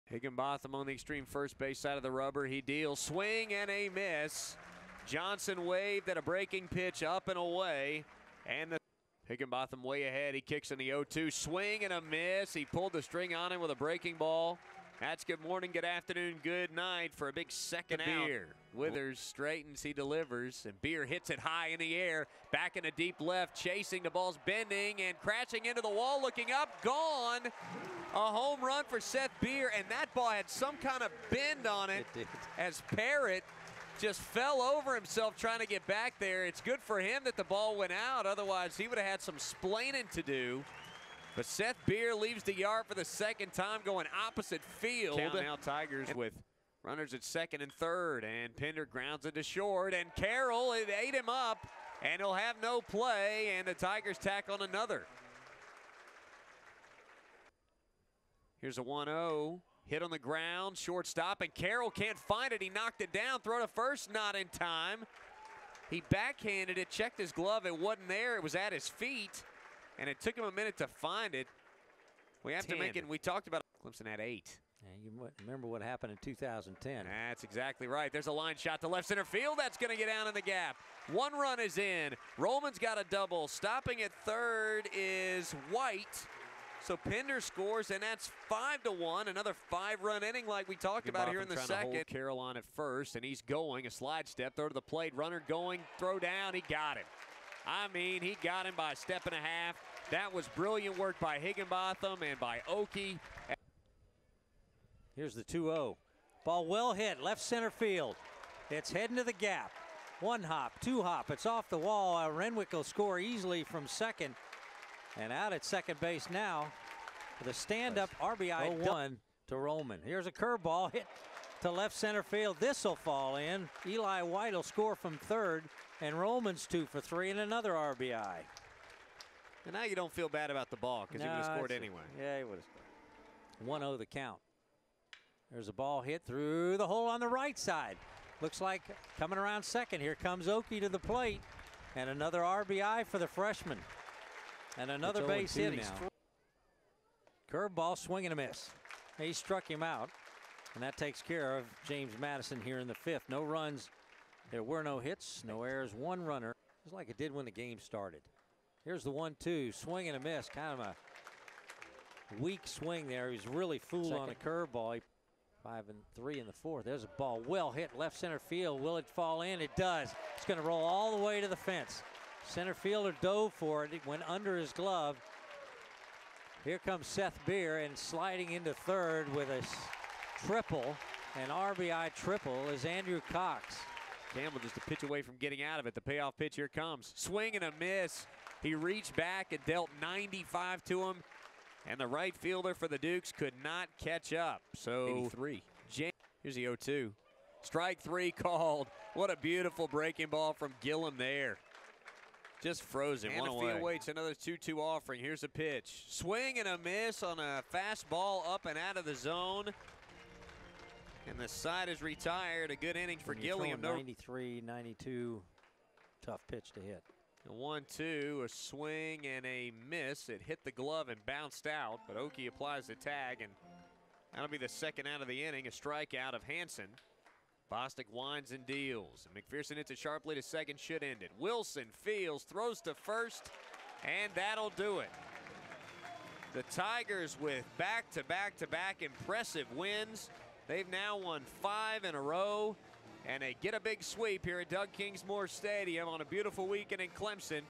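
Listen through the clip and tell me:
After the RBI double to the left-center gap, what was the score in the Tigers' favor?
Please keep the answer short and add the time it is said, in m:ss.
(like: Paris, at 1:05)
5 to 1, at 1:28.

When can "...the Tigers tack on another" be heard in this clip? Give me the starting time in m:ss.
0:53.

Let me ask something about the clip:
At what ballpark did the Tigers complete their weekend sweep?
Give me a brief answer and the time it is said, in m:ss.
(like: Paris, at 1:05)
Doug Kingsmore Stadium, at 4:04.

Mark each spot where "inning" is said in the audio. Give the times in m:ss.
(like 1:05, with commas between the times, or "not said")
1:30, 3:32, 3:45.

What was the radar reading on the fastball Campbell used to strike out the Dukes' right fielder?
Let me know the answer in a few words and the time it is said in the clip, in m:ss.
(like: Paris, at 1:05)
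95, at 3:10.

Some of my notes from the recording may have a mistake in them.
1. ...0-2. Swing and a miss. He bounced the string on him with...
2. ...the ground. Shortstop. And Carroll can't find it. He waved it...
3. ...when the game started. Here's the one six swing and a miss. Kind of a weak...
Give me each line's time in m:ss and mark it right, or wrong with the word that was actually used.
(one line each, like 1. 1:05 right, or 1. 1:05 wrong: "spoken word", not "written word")
1. 0:10 wrong: "pulled", not "bounced"
2. 1:00 wrong: "knocked", not "waved"
3. 2:37 wrong: "two", not "six".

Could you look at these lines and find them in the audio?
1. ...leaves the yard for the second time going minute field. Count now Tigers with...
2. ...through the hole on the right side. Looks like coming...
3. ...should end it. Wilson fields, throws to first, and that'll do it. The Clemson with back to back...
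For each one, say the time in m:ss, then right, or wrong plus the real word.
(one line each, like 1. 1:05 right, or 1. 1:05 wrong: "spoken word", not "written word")
1. 0:42 wrong: "opposite", not "minute"
2. 2:16 right
3. 3:50 wrong: "Tigers", not "Clemson".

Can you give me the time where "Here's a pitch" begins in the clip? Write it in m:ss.
3:25.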